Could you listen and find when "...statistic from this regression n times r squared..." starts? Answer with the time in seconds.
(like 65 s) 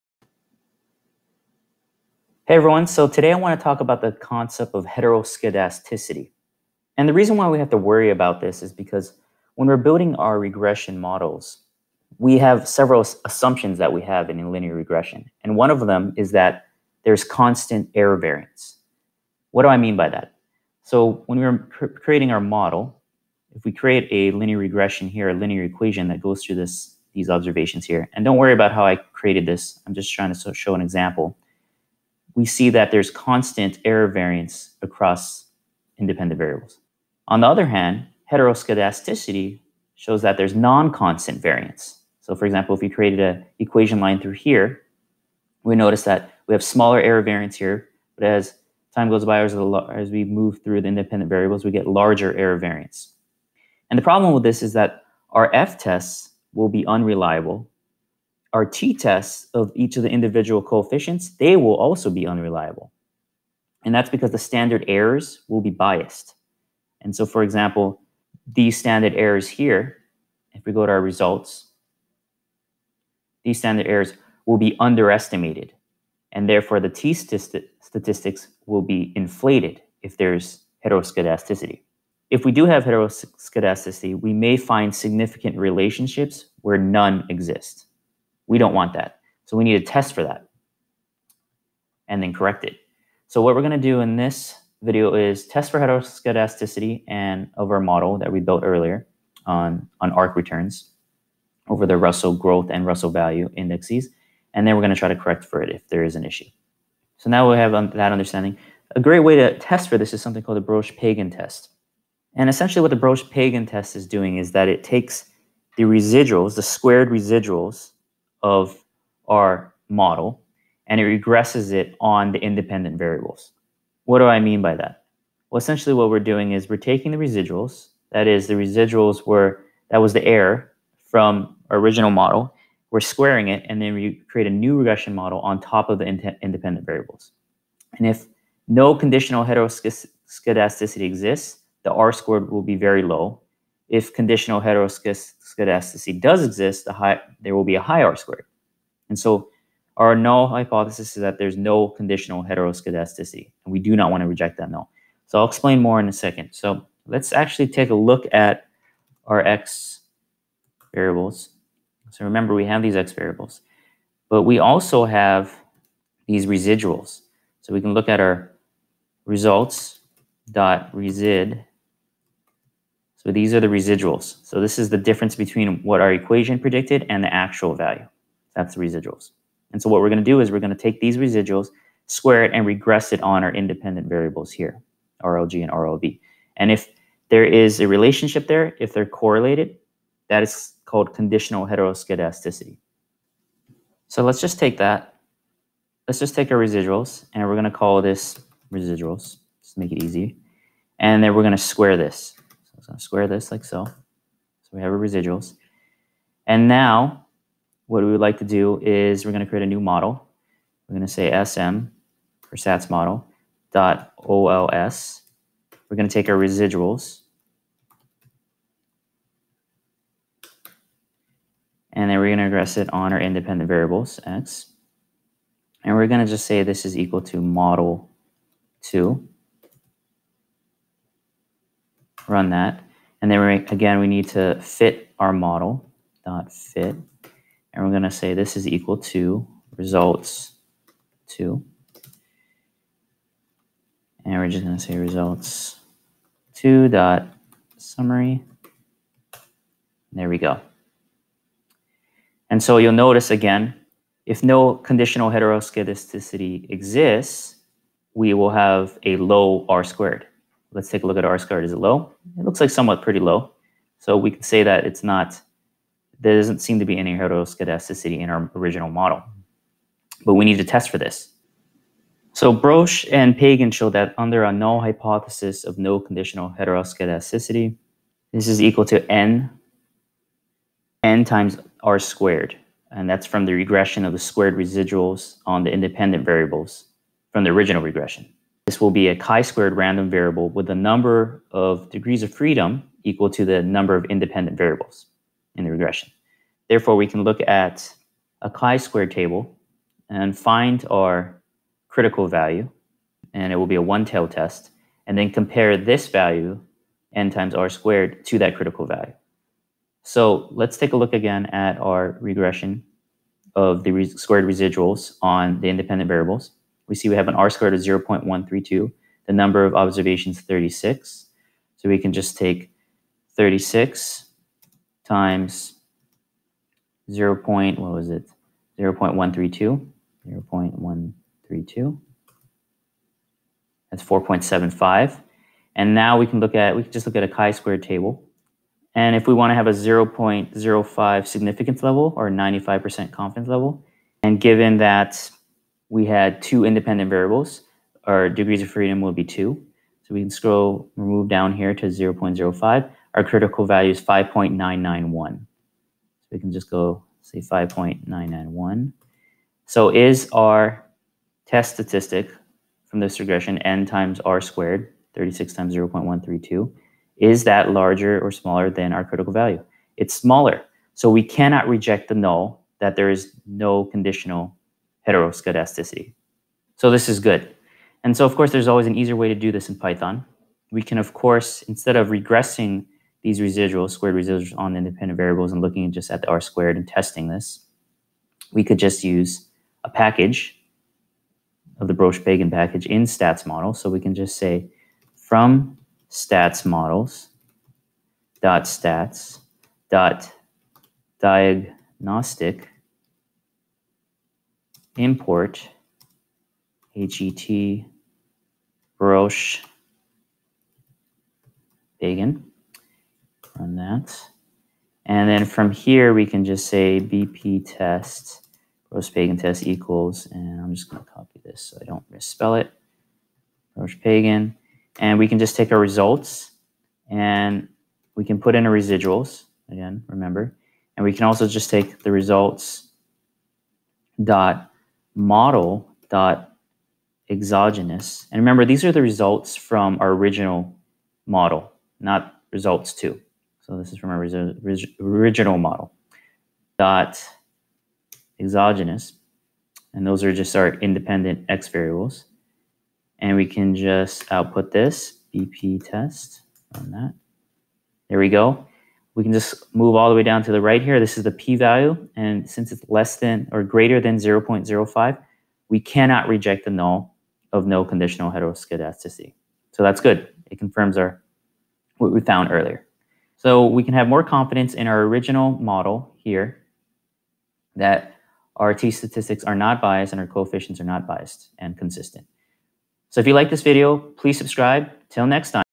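361 s.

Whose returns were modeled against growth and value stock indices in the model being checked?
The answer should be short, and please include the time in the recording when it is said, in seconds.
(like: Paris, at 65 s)
ARK, at 100 s.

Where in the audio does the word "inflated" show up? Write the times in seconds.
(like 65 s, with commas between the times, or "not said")
79 s.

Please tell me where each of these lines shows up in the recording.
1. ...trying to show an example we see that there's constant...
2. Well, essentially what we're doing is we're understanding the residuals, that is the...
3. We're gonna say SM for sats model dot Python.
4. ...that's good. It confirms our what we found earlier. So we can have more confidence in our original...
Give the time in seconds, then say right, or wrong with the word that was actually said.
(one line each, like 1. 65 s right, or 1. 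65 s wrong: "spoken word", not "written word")
1. 30 s right
2. 125 s wrong: "taking", not "understanding"
3. 210 s wrong: "OLS", not "Python"
4. 469 s right.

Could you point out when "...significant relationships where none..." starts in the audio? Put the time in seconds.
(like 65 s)
84 s.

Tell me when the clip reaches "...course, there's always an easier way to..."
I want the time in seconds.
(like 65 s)
378 s.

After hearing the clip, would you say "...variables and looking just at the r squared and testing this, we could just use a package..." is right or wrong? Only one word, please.
right.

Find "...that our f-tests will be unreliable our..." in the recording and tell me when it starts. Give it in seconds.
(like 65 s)
54 s.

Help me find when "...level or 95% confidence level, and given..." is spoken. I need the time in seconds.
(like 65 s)
341 s.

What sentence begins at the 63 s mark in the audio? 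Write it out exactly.
And that's because the standard errors will be biased.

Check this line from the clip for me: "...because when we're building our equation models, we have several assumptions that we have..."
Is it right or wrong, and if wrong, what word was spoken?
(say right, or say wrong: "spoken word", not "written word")
wrong: "regression", not "equation".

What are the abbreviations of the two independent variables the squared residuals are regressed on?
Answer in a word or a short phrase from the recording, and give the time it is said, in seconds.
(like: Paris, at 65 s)
RLG and RLB, at 185 s.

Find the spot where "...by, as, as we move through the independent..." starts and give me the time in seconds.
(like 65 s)
49 s.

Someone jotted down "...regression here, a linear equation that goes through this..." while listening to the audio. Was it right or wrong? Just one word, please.
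right.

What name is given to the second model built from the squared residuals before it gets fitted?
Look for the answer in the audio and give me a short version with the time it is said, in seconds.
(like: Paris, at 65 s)
model 2, at 227 s.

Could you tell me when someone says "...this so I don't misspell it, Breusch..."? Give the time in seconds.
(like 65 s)
421 s.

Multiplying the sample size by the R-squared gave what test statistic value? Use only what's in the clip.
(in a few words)
4.75.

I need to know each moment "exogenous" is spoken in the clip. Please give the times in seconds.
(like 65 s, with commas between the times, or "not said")
437 s, 448 s.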